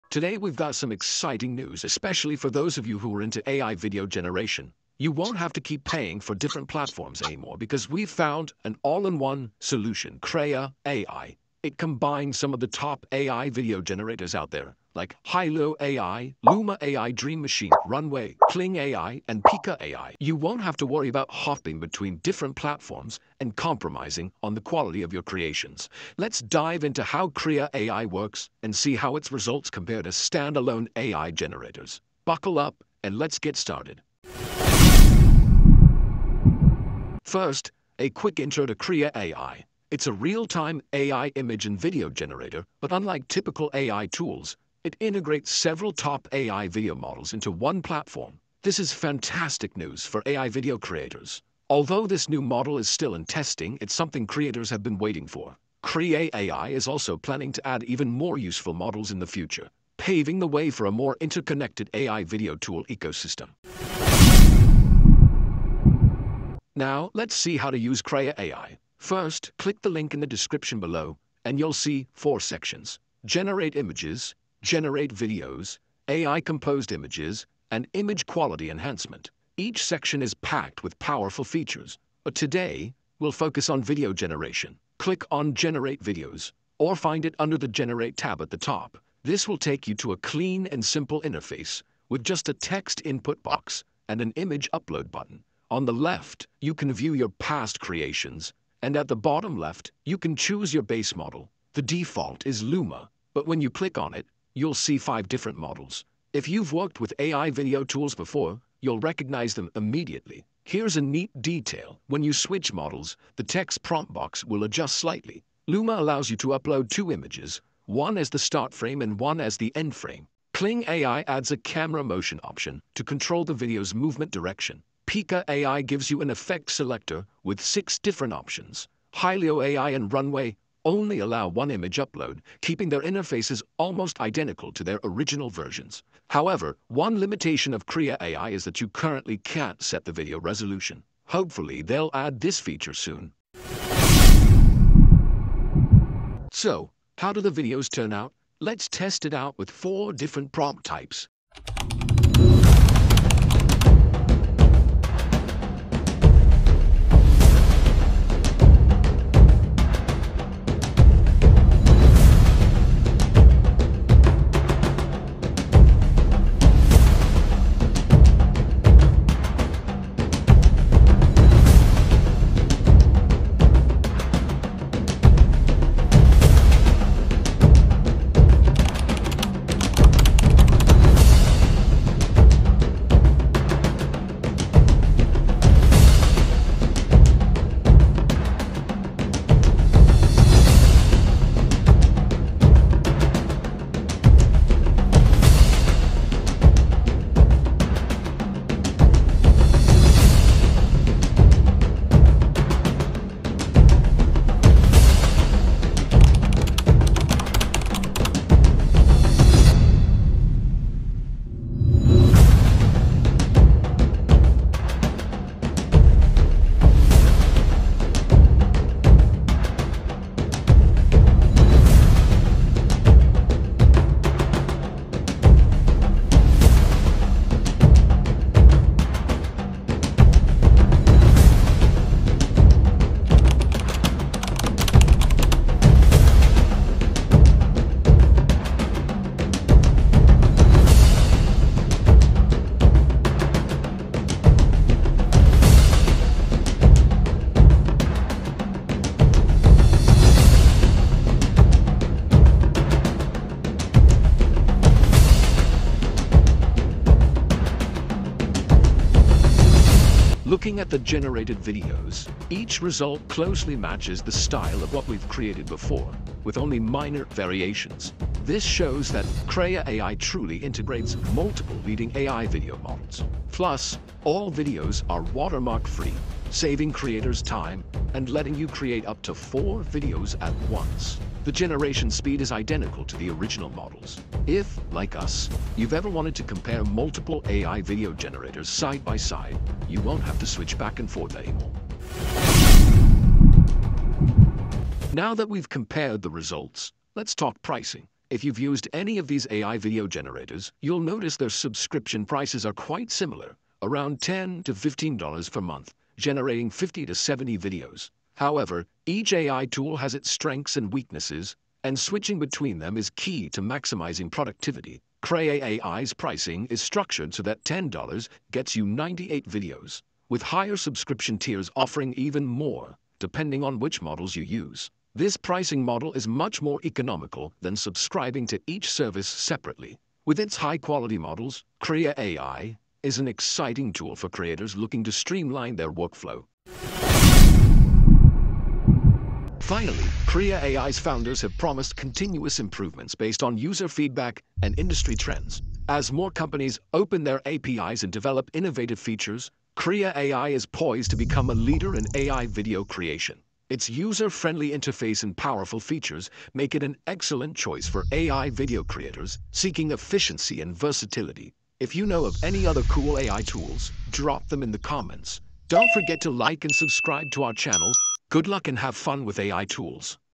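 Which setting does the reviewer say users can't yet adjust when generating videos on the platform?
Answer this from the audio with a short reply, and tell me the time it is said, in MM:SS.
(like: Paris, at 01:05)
video resolution, at 02:20.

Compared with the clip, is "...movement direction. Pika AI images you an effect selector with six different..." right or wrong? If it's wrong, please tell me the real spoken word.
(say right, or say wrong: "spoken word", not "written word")
wrong: "gives", not "images".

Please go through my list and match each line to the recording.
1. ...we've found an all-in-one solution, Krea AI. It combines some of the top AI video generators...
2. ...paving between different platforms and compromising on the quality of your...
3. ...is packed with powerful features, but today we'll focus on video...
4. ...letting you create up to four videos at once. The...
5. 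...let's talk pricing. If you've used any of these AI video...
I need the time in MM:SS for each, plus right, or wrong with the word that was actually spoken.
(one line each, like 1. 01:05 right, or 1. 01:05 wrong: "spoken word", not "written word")
1. 00:07 right
2. 00:21 wrong: "hopping", not "paving"
3. 01:20 right
4. 04:38 right
5. 04:57 right.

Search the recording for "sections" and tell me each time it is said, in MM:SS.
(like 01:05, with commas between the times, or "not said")
01:12, 01:19.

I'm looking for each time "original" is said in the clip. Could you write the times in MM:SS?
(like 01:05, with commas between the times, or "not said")
02:15, 04:43.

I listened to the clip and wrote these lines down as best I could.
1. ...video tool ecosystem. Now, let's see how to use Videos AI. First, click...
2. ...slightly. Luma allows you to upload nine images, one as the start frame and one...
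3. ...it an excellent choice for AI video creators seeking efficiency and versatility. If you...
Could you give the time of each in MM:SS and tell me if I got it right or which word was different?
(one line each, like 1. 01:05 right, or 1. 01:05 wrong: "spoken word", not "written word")
1. 01:02 wrong: "Krea", not "Videos"
2. 01:54 wrong: "two", not "nine"
3. 05:56 right.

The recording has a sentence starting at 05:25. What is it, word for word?
This pricing model is much more economical than subscribing to each service separately.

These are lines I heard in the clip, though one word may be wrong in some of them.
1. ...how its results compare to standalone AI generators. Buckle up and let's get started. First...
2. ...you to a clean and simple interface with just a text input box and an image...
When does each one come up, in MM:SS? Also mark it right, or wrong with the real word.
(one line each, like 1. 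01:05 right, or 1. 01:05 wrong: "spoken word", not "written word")
1. 00:28 right
2. 01:29 right.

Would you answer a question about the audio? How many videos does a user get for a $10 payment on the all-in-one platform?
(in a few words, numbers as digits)
98.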